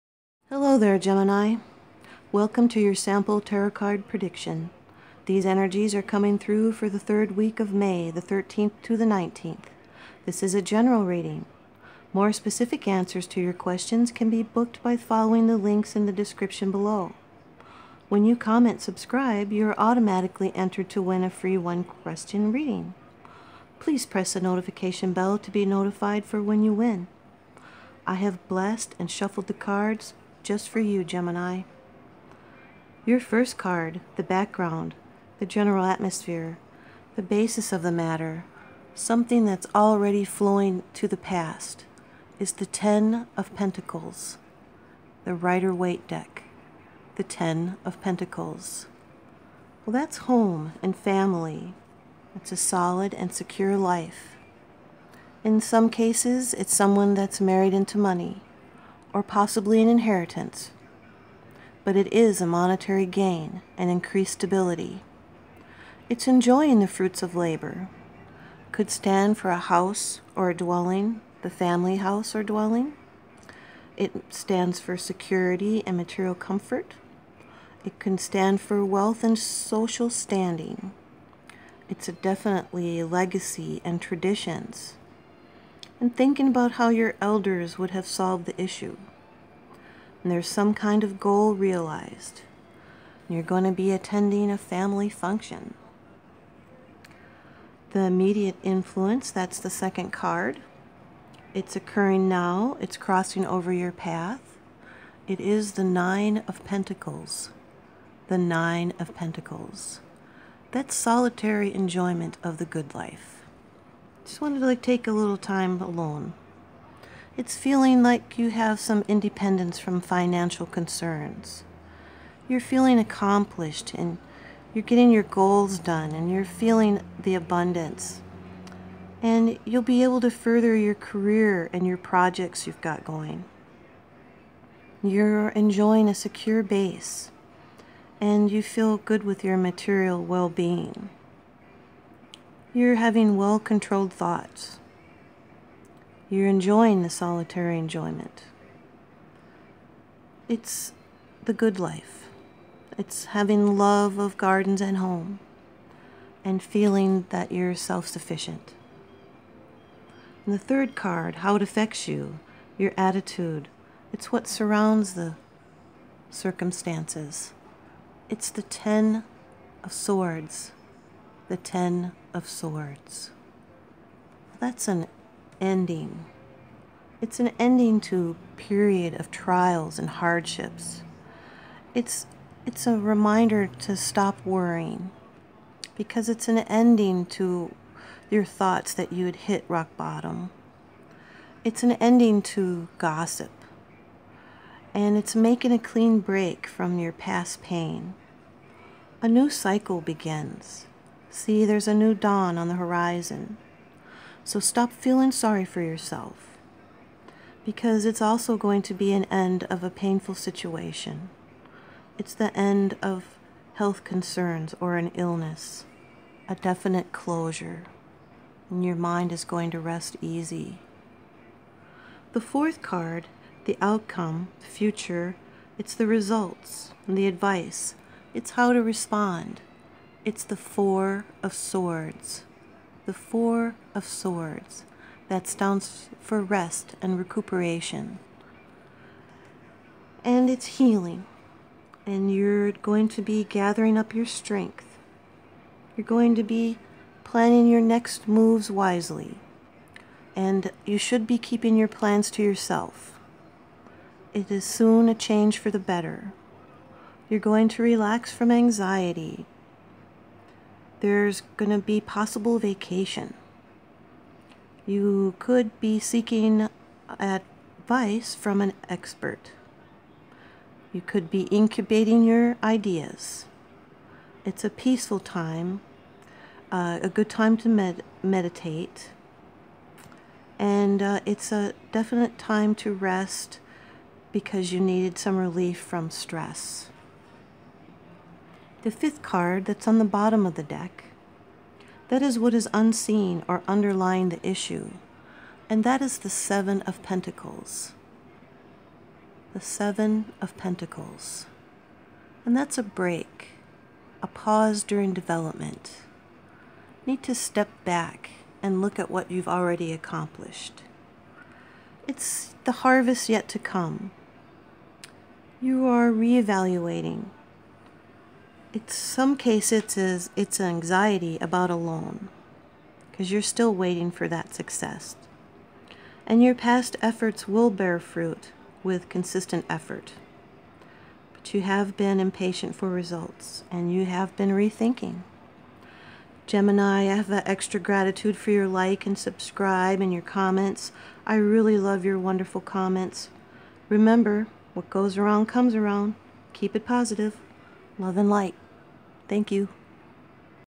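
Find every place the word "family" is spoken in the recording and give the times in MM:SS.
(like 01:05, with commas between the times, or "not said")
00:50, 01:11, 01:34.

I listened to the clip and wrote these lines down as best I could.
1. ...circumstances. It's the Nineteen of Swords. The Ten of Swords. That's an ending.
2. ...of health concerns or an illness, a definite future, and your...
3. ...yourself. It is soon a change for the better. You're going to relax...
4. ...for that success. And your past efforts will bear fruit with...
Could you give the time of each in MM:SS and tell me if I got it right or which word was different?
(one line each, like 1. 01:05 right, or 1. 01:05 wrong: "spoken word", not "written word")
1. 02:46 wrong: "Ten", not "Nineteen"
2. 03:33 wrong: "closure", not "future"
3. 04:12 right
4. 05:24 right.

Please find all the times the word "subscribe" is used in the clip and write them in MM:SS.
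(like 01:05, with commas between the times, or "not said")
00:18, 05:39.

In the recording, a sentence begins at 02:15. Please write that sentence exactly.
You're enjoying a secure base and you feel good with your material well being.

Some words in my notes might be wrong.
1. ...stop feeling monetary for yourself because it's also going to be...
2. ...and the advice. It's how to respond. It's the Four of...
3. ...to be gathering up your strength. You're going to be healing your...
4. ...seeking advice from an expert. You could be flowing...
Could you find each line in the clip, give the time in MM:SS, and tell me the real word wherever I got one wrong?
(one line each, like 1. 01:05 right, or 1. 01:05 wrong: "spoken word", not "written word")
1. 03:24 wrong: "sorry", not "monetary"
2. 03:47 right
3. 04:03 wrong: "planning", not "healing"
4. 04:25 wrong: "incubating", not "flowing".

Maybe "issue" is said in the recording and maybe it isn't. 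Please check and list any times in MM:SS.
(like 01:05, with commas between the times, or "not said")
01:28, 04:54.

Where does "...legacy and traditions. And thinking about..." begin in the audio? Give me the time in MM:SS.
01:23.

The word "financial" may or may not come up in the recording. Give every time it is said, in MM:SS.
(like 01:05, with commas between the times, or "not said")
02:00.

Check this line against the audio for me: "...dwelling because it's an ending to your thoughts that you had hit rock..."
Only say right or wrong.
wrong.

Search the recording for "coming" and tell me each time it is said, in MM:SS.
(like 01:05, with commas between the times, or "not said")
00:06.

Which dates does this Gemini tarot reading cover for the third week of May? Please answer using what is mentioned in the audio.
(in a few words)
13th to the 19th.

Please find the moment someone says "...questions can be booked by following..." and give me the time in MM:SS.
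00:13.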